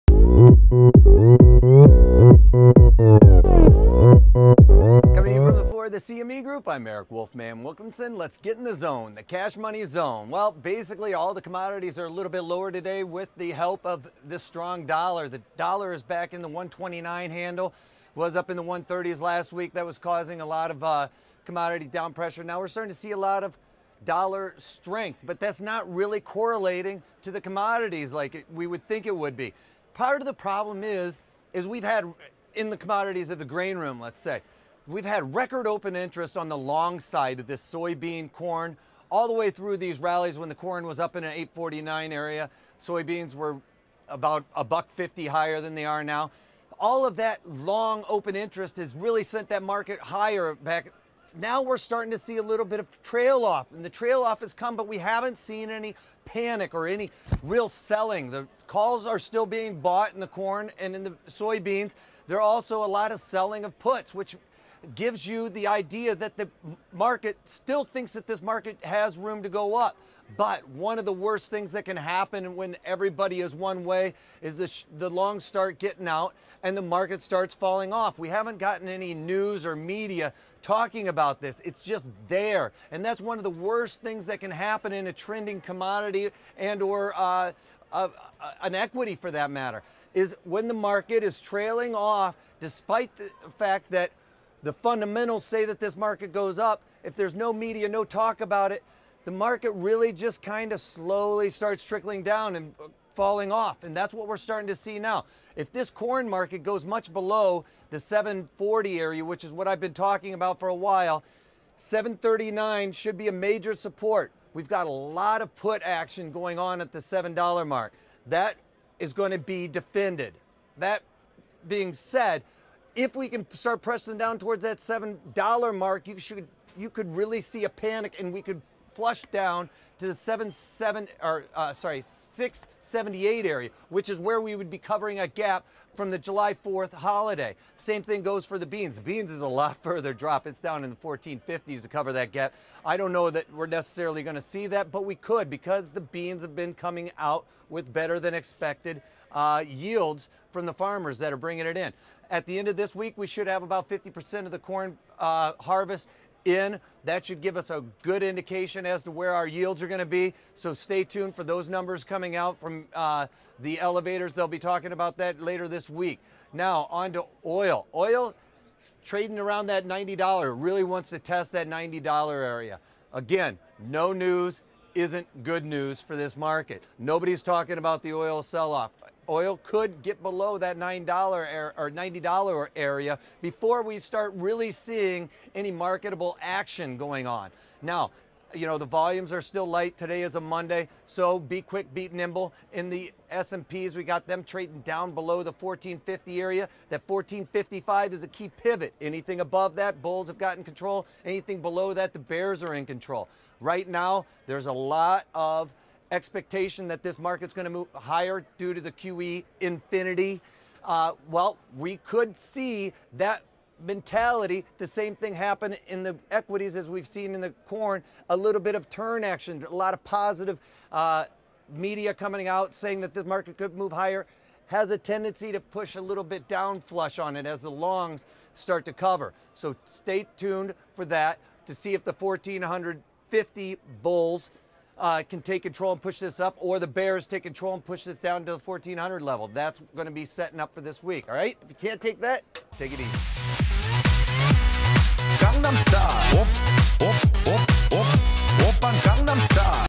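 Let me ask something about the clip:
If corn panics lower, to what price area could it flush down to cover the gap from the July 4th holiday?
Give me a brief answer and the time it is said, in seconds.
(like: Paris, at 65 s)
678, at 132 s.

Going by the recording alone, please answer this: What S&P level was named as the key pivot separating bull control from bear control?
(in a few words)
1455.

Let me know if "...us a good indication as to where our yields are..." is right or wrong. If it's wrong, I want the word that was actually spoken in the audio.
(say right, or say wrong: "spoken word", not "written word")
right.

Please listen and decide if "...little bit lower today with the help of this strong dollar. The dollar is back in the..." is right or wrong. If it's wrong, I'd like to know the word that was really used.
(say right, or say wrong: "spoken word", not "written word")
right.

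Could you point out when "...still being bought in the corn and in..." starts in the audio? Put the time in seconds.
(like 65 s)
59 s.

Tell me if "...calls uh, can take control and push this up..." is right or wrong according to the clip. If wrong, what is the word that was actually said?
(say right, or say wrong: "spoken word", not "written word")
wrong: "bulls", not "calls".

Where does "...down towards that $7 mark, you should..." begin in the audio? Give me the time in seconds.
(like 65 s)
124 s.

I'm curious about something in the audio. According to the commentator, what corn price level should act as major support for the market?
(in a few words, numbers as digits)
739.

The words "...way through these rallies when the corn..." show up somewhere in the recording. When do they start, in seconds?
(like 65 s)
39 s.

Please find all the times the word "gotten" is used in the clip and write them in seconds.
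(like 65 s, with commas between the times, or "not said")
78 s, 200 s.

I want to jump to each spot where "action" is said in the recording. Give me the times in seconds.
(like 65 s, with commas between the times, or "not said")
115 s, 186 s, 219 s.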